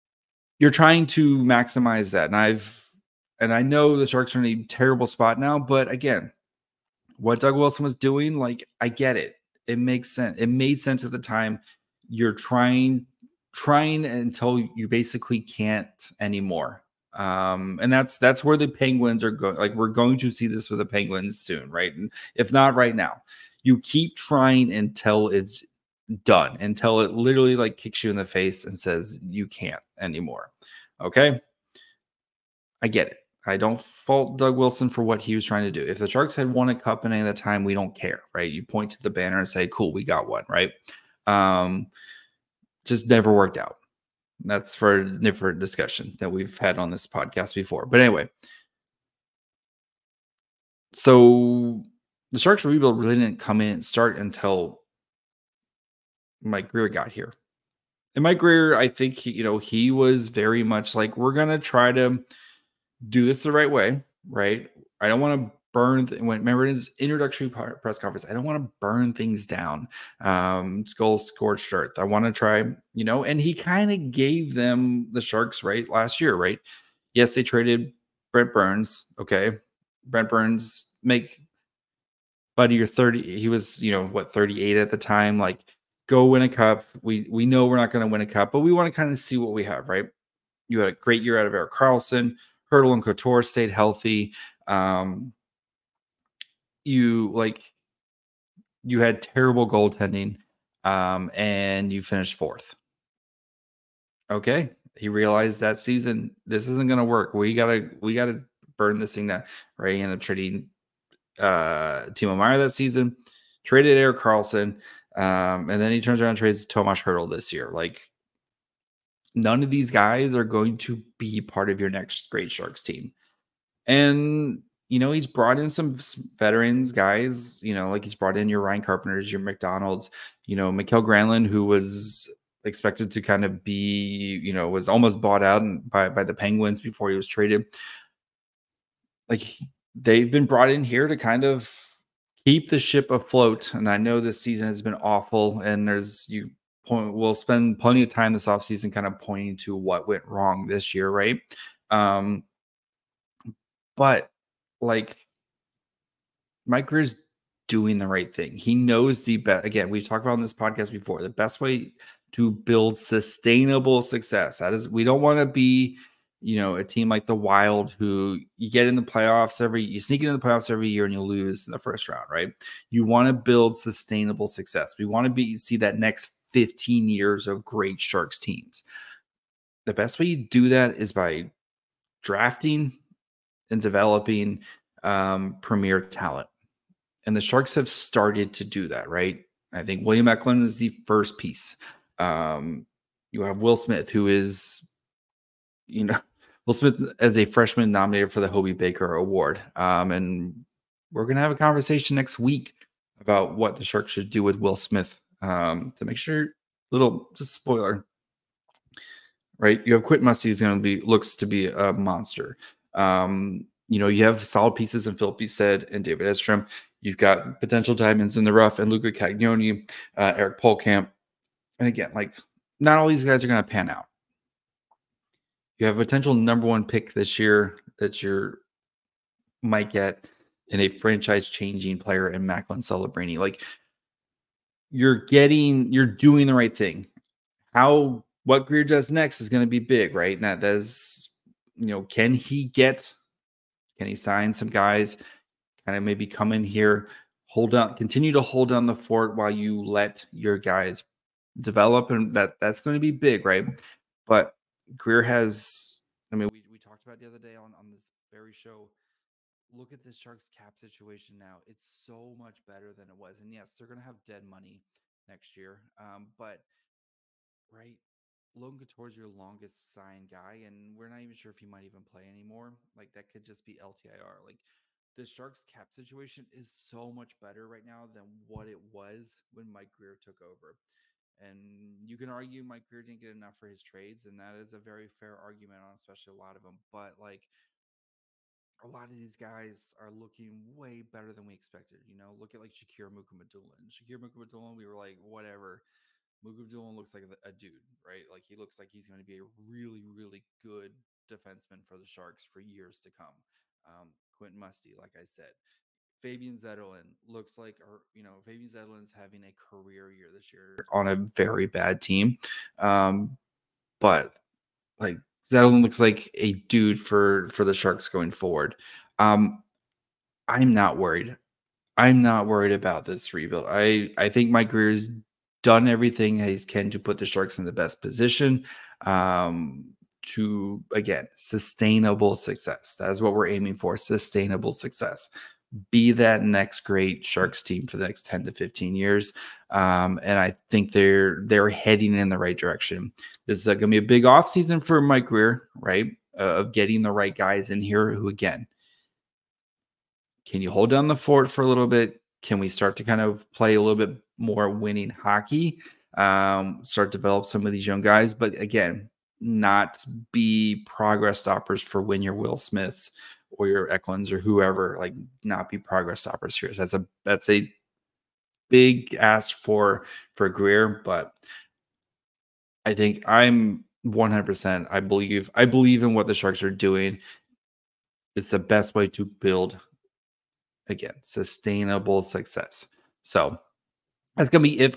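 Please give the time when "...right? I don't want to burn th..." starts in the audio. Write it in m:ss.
1:04.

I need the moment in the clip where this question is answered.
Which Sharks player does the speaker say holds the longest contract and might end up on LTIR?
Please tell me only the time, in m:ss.
4:28.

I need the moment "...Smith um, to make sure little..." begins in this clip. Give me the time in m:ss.
3:24.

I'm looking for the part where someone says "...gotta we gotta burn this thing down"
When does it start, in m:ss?
1:47.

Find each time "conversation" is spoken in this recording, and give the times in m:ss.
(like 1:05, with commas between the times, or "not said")
3:21.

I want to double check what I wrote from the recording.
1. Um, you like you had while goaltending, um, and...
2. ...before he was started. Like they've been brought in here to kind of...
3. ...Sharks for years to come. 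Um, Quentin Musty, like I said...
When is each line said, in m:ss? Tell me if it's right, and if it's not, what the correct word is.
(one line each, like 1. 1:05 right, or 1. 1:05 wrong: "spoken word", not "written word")
1. 1:34 wrong: "terrible", not "while"
2. 2:16 wrong: "traded", not "started"
3. 5:02 right.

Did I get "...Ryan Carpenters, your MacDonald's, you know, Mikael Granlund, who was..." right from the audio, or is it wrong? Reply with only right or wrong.
right.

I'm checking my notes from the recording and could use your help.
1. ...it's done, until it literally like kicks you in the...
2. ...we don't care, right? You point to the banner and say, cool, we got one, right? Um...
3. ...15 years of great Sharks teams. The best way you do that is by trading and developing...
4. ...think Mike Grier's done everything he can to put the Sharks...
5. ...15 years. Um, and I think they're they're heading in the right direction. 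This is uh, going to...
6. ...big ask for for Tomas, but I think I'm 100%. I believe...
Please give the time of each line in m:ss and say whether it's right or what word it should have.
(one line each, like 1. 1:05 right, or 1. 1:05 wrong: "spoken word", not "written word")
1. 0:25 right
2. 0:37 right
3. 2:56 wrong: "drafting", not "trading"
4. 5:24 right
5. 5:38 right
6. 6:08 wrong: "Grier", not "Tomas".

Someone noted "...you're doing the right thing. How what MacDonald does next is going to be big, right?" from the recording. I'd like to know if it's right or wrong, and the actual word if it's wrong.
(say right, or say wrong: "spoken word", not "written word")
wrong: "Grier", not "MacDonald".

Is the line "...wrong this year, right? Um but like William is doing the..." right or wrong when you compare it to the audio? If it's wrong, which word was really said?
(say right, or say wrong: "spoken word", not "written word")
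wrong: "Mike", not "William".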